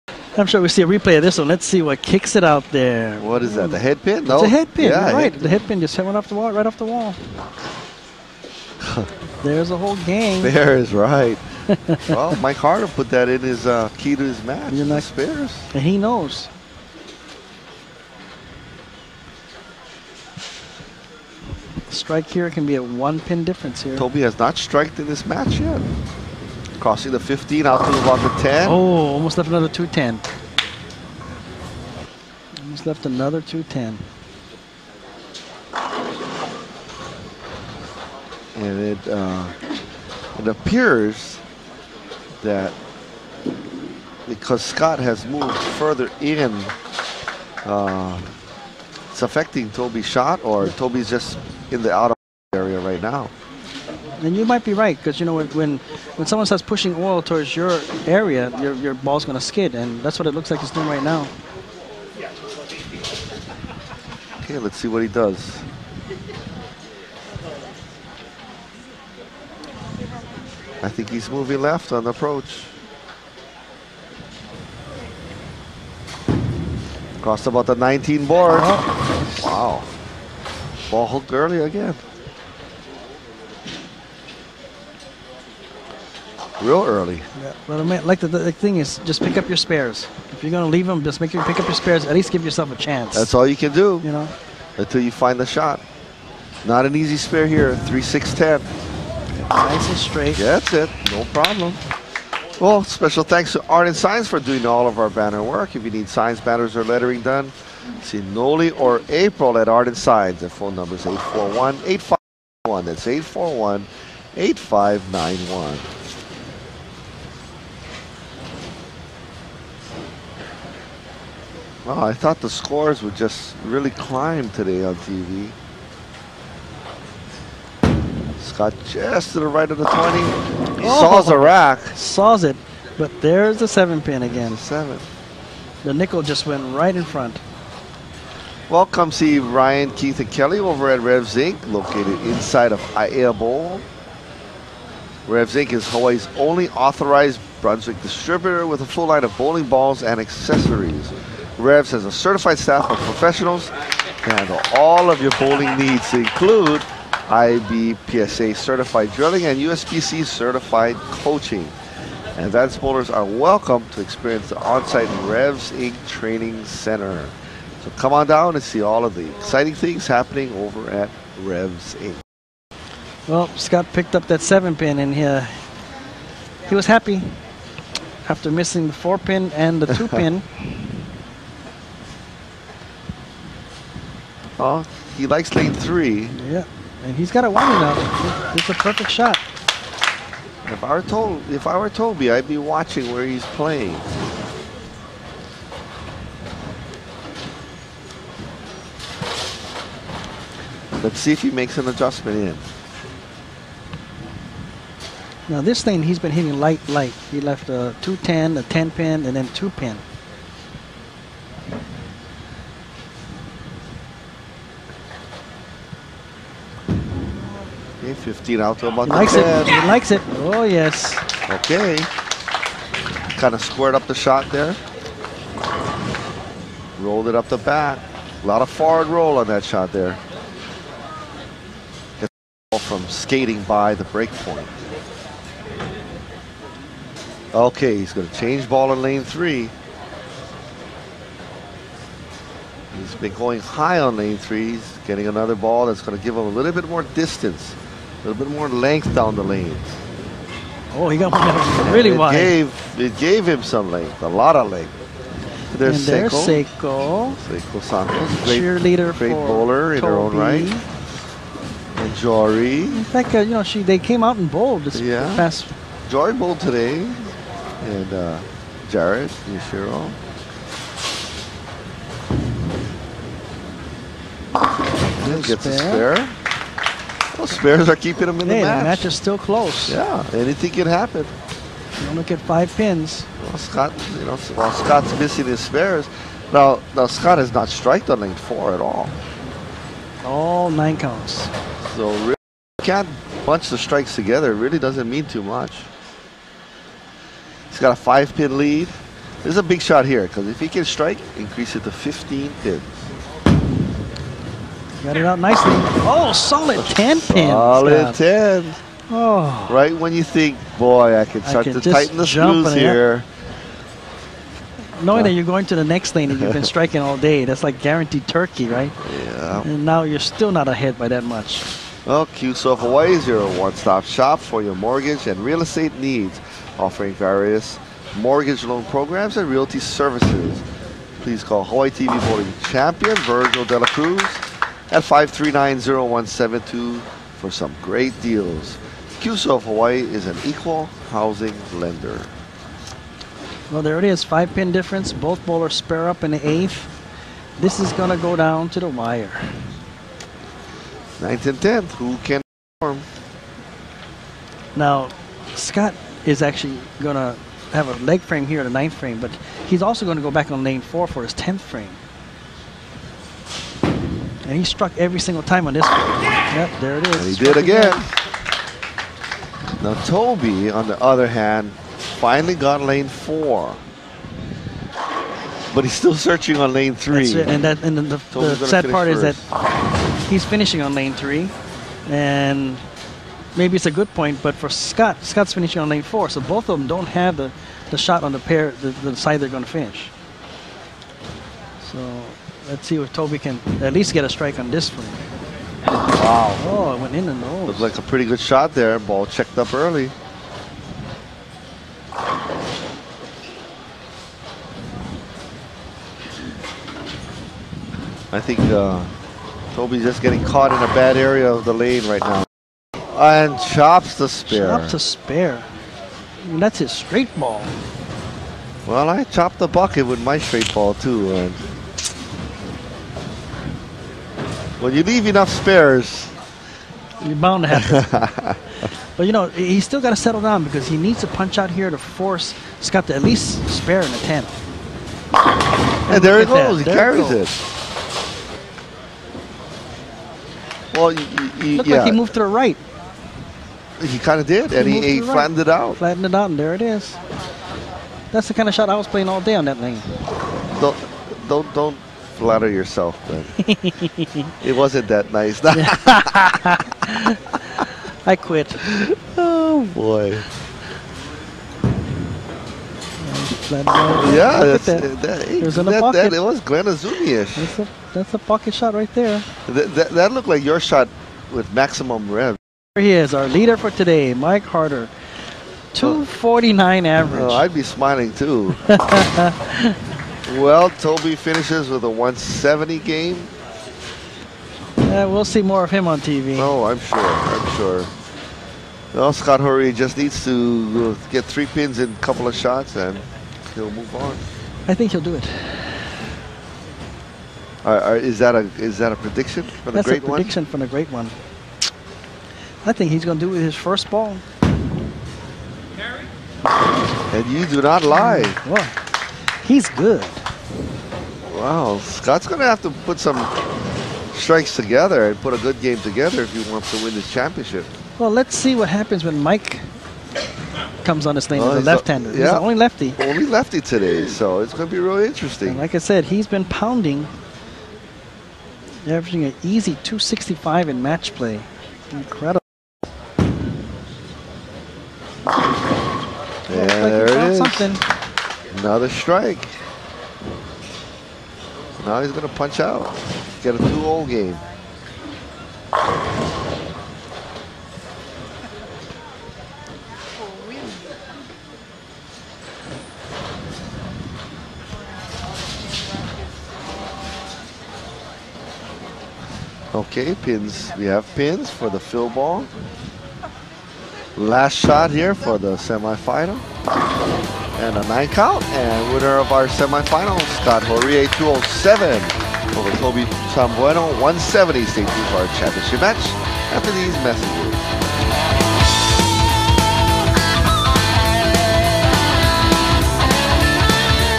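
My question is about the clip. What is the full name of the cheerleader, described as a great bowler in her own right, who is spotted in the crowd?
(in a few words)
Seiko Santos.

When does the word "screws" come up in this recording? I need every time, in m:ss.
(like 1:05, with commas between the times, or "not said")
5:12.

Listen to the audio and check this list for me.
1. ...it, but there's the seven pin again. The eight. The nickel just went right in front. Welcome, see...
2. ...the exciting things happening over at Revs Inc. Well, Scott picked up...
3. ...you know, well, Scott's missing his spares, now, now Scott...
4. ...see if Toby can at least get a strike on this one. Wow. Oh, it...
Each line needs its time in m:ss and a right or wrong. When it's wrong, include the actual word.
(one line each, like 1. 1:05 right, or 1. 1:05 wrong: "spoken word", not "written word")
1. 2:12 wrong: "seven", not "eight"
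2. 2:49 right
3. 4:44 right
4. 6:32 right.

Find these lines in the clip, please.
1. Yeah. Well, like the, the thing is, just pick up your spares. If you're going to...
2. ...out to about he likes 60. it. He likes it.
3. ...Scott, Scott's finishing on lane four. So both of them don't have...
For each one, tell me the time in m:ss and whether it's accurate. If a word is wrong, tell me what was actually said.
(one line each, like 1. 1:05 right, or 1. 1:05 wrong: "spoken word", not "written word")
1. 1:27 right
2. 3:38 wrong: "10", not "60"
3. 6:24 right.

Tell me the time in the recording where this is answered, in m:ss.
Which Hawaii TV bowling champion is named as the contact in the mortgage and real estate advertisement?
5:33.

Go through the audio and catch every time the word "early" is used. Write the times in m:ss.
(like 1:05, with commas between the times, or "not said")
1:21, 1:26, 6:39.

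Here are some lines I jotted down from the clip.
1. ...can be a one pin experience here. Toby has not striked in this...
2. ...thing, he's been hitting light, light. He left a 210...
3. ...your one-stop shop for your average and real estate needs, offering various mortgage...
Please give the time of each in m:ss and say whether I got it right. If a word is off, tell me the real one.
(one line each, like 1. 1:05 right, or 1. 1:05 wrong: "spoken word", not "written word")
1. 0:22 wrong: "difference", not "experience"
2. 3:25 right
3. 5:23 wrong: "mortgage", not "average".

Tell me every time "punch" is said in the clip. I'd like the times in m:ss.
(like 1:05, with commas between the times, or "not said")
7:11, 9:02.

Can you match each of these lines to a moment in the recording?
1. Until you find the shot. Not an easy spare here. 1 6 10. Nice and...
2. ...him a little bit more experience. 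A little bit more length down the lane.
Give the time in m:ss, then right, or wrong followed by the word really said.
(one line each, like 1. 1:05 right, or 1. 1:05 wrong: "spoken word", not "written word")
1. 1:34 wrong: "3", not "1"
2. 4:06 wrong: "distance", not "experience".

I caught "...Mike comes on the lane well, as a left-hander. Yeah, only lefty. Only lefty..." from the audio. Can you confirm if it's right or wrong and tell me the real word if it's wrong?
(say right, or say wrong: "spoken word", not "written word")
right.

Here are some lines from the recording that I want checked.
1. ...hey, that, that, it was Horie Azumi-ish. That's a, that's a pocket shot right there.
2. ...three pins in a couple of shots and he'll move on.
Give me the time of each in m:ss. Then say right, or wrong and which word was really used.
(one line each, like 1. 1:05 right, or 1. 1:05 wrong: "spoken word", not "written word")
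1. 7:45 wrong: "Glen", not "Horie"
2. 8:11 right.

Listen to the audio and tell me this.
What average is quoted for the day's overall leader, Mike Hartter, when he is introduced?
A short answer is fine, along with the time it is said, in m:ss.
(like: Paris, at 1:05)
249, at 7:55.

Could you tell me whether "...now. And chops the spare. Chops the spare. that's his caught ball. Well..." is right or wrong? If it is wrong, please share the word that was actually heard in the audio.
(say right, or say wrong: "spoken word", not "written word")
wrong: "straight", not "caught".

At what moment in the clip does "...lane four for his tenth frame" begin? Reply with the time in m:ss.
6:00.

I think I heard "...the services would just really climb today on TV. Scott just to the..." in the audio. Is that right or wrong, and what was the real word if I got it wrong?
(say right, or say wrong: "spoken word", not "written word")
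wrong: "scores", not "services".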